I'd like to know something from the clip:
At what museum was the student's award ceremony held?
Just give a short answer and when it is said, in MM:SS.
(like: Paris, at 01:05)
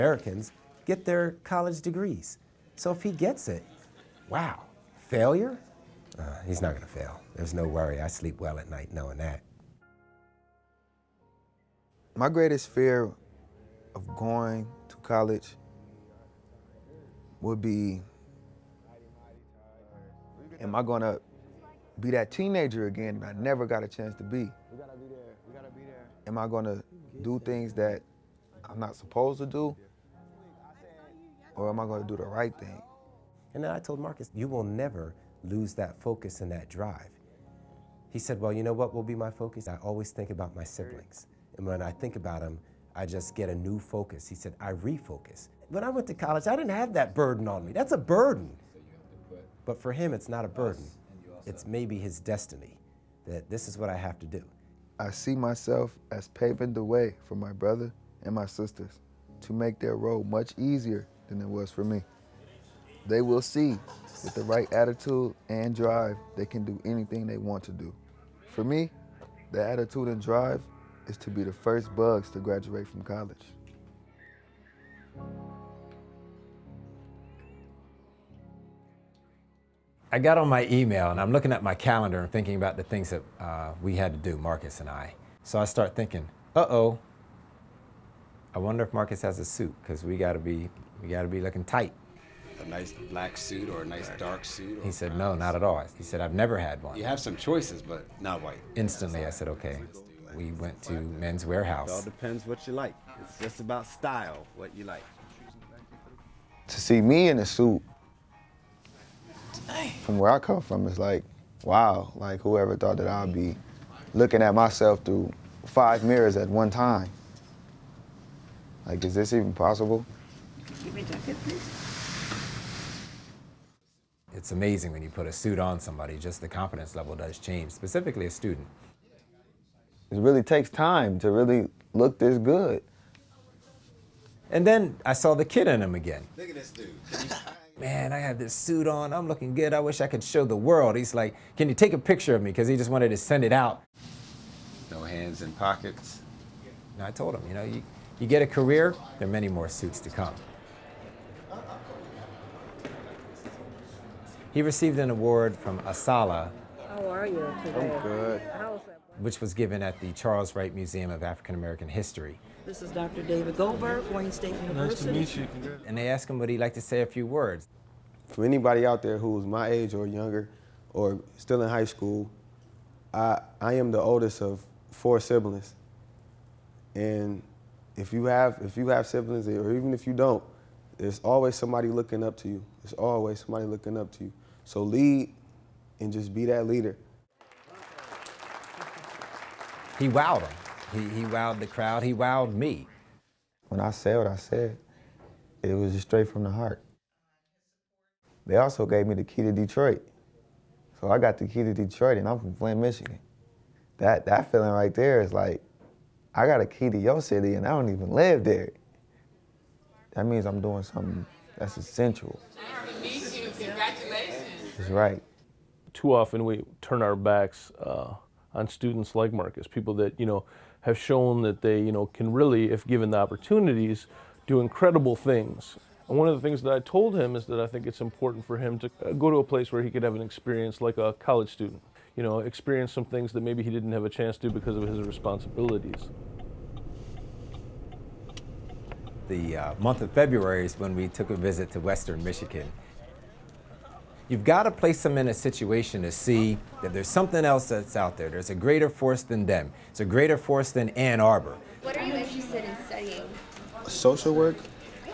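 Charles Wright Museum of African American History, at 02:40.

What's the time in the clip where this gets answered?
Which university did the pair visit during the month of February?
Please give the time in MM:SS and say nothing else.
04:01.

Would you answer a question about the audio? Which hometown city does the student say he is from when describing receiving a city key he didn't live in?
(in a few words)
Flint, Michigan.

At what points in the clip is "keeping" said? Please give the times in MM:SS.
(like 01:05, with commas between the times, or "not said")
not said.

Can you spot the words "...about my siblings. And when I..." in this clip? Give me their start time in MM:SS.
00:40.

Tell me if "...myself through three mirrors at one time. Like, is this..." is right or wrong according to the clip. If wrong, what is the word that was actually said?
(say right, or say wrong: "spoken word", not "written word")
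wrong: "five", not "three".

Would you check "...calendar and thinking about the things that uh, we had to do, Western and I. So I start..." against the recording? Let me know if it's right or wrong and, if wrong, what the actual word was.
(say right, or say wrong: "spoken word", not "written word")
wrong: "Marcus", not "Western".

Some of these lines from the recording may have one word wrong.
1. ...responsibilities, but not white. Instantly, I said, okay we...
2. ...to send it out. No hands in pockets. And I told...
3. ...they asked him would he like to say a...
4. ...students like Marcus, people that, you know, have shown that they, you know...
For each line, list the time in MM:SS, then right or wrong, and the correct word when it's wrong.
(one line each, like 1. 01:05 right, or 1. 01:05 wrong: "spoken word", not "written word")
1. 01:37 wrong: "choices", not "responsibilities"
2. 02:23 right
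3. 02:45 right
4. 03:38 right.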